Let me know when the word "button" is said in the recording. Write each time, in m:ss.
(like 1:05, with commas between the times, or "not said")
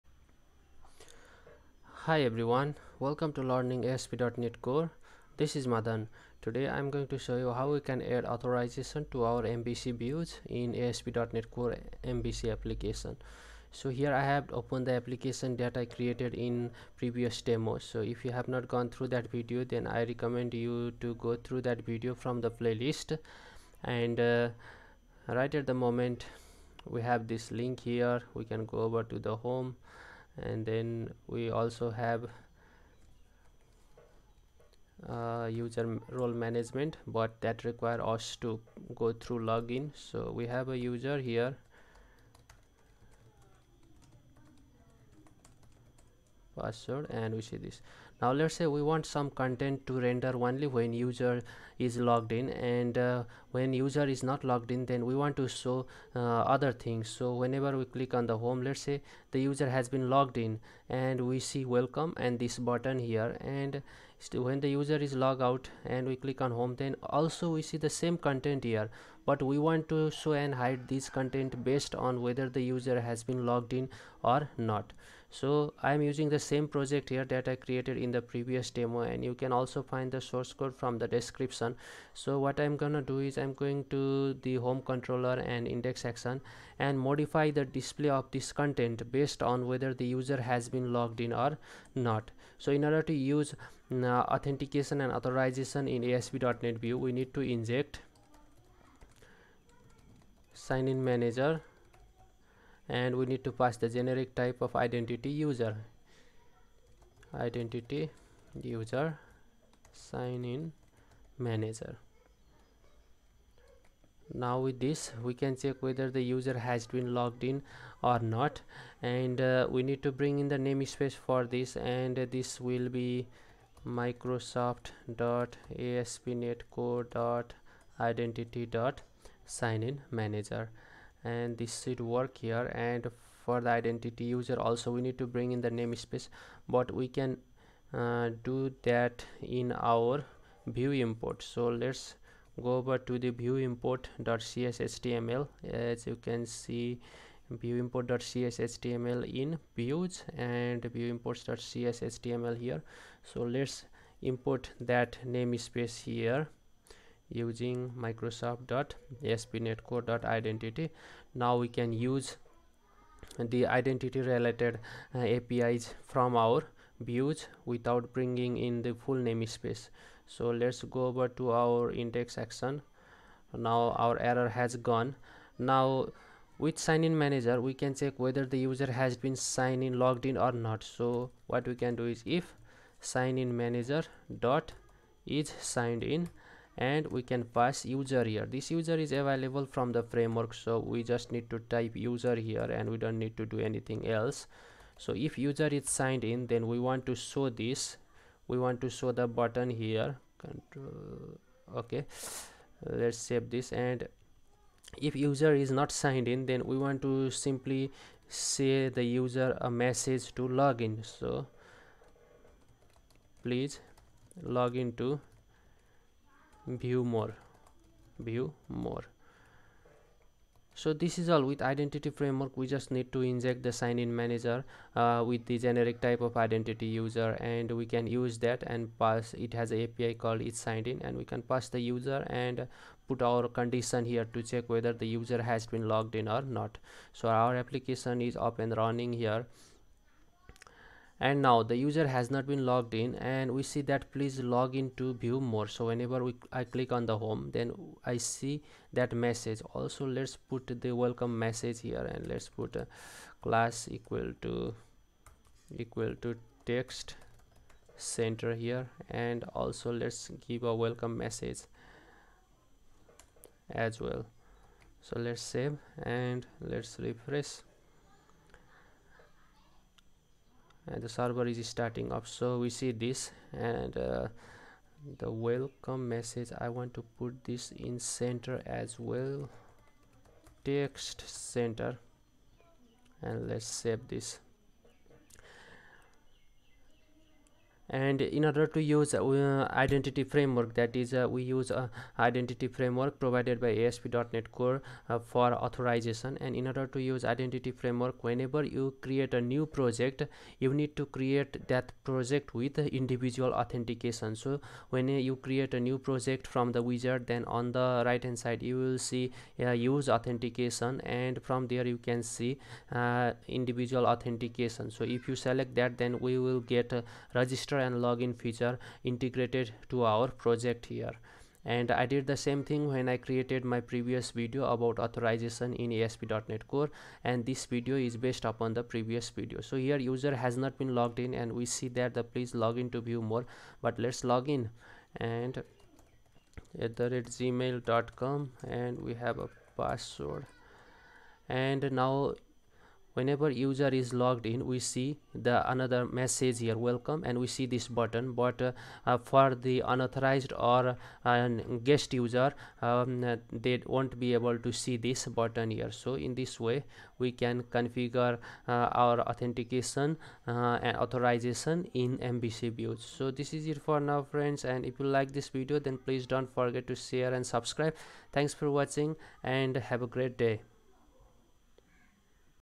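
1:02, 3:19, 5:47, 5:55.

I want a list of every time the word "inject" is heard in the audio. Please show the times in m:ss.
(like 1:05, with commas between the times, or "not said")
1:37, 3:43.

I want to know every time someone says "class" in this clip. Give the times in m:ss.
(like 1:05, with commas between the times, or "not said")
4:13.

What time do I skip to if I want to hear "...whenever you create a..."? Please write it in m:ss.
4:58.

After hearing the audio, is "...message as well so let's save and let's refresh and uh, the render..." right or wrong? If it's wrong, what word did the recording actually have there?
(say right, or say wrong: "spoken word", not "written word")
wrong: "server", not "render".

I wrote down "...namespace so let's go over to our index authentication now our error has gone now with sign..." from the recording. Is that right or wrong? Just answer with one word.
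wrong.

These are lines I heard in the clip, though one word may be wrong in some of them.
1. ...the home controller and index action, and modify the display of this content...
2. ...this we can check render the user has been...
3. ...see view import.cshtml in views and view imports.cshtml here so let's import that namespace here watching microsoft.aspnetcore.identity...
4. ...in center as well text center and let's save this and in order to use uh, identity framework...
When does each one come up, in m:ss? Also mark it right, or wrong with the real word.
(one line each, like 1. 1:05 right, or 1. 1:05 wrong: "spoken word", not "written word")
1. 1:24 right
2. 1:54 wrong: "whether", not "render"
3. 2:26 wrong: "using", not "watching"
4. 4:37 right.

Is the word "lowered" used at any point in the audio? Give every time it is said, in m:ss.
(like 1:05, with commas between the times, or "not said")
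not said.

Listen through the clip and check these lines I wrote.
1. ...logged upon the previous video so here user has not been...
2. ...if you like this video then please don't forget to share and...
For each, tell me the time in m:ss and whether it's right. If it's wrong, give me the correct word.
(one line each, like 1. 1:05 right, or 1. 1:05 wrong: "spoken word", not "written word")
1. 5:28 wrong: "based", not "logged"
2. 6:04 right.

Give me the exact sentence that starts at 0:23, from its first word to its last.
And uh, right at the moment, we have this link here.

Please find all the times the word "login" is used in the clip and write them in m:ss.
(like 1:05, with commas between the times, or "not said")
0:39, 3:30, 5:18.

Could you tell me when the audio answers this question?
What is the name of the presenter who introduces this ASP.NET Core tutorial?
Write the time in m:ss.
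0:05.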